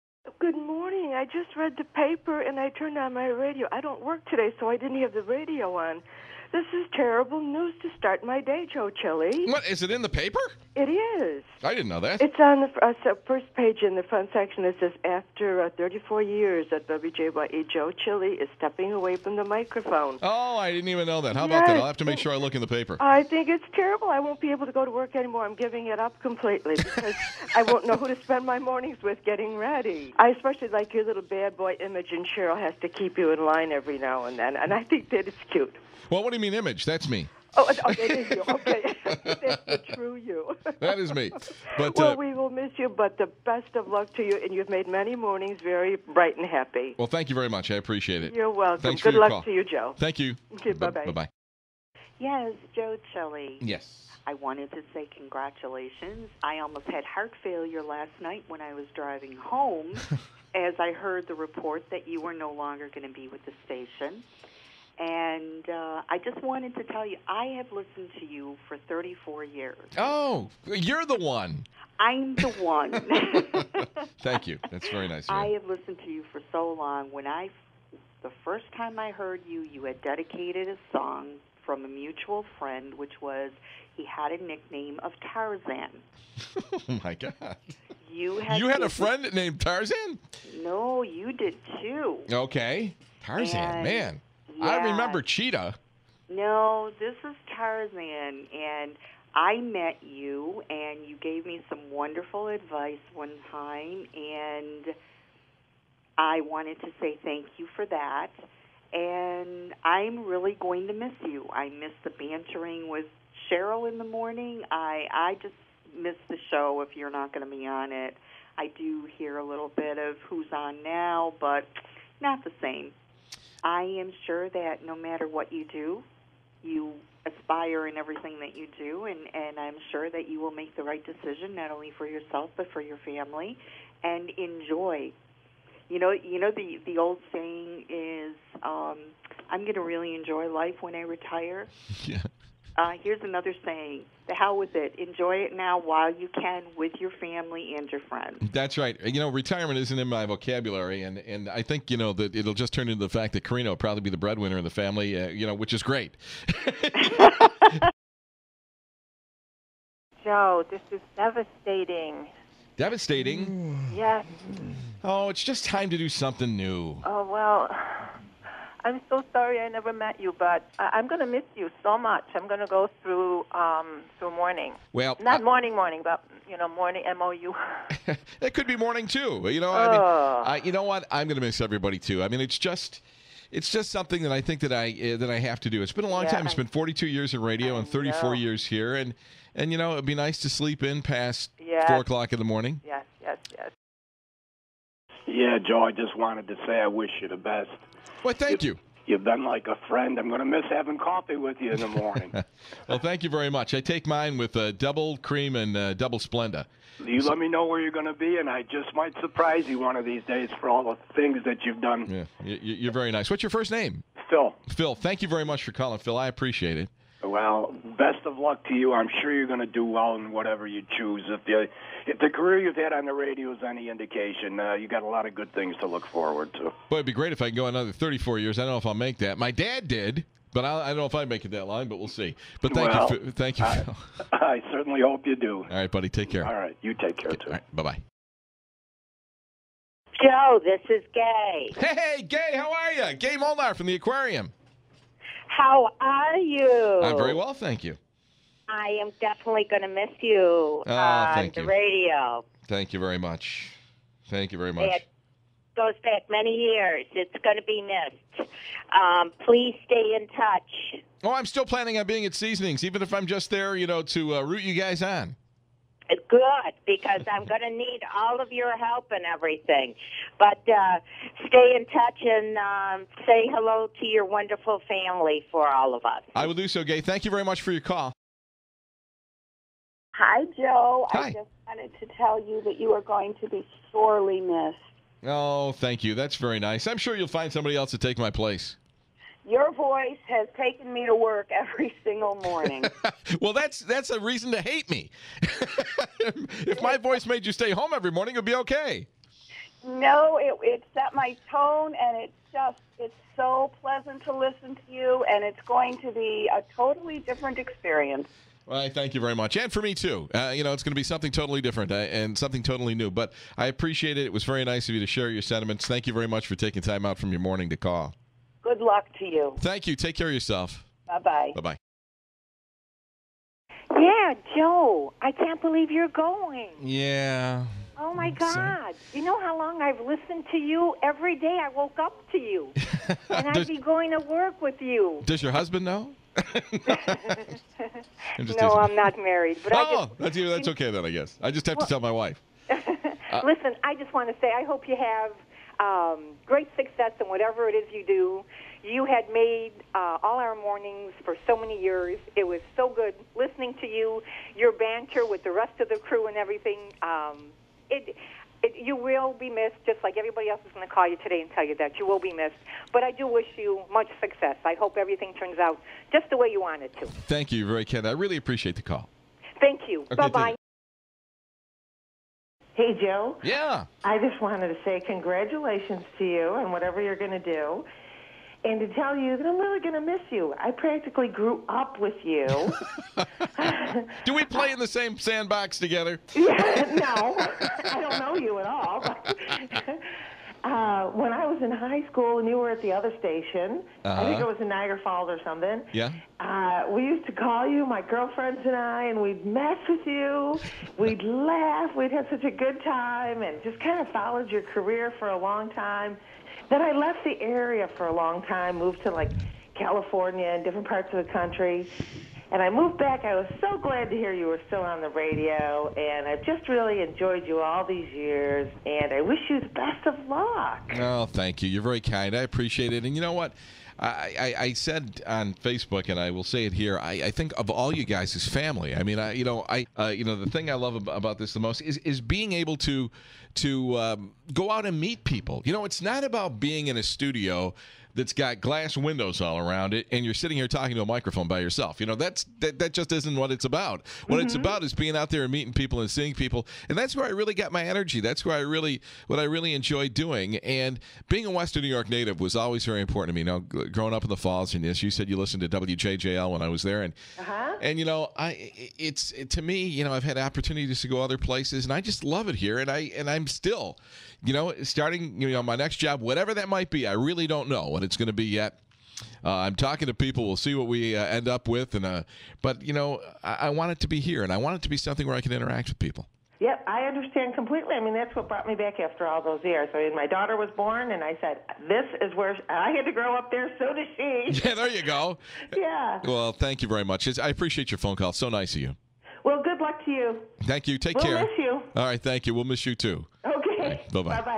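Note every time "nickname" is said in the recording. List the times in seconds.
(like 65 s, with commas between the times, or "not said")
84 s.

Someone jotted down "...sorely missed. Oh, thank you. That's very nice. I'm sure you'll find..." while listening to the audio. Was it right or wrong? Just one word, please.
right.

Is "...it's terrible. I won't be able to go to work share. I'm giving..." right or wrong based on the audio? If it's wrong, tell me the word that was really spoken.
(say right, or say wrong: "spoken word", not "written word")
wrong: "anymore", not "share".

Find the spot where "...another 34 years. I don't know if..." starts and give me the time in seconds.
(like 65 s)
227 s.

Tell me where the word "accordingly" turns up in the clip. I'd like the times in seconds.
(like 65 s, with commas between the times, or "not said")
not said.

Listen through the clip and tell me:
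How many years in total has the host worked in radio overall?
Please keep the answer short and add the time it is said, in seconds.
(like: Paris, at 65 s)
42, at 186 s.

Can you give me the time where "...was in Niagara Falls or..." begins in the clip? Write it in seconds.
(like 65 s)
394 s.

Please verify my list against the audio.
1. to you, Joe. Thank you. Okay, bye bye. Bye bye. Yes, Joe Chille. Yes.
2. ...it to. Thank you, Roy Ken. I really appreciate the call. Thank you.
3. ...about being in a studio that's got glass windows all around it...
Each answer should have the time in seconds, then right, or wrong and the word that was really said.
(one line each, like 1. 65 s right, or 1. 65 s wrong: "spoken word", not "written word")
1. 49 s right
2. 366 s right
3. 436 s right.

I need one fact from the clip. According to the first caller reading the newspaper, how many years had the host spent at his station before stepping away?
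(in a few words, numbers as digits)
34.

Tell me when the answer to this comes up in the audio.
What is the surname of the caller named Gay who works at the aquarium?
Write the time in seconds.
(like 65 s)
243 s.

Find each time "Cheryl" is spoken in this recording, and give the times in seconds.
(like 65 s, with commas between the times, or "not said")
32 s, 113 s.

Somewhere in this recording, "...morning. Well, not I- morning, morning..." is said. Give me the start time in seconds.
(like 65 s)
174 s.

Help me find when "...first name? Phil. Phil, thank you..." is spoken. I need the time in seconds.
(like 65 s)
213 s.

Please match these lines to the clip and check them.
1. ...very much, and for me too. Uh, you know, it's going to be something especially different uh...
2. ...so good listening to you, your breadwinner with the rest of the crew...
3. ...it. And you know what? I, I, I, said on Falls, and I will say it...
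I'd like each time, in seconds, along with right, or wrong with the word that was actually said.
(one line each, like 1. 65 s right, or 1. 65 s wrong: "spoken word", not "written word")
1. 309 s wrong: "totally", not "especially"
2. 352 s wrong: "banter", not "breadwinner"
3. 422 s wrong: "Facebook", not "Falls".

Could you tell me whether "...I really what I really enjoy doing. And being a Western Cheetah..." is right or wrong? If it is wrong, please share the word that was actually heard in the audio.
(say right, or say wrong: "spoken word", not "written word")
wrong: "New", not "Cheetah".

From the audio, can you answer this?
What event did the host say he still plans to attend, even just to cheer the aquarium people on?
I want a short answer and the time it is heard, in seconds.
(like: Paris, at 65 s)
Seasonings, at 262 s.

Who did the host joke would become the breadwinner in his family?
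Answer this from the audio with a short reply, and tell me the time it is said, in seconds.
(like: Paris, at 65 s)
Karina, at 153 s.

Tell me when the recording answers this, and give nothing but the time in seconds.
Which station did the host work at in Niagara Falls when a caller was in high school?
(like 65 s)
455 s.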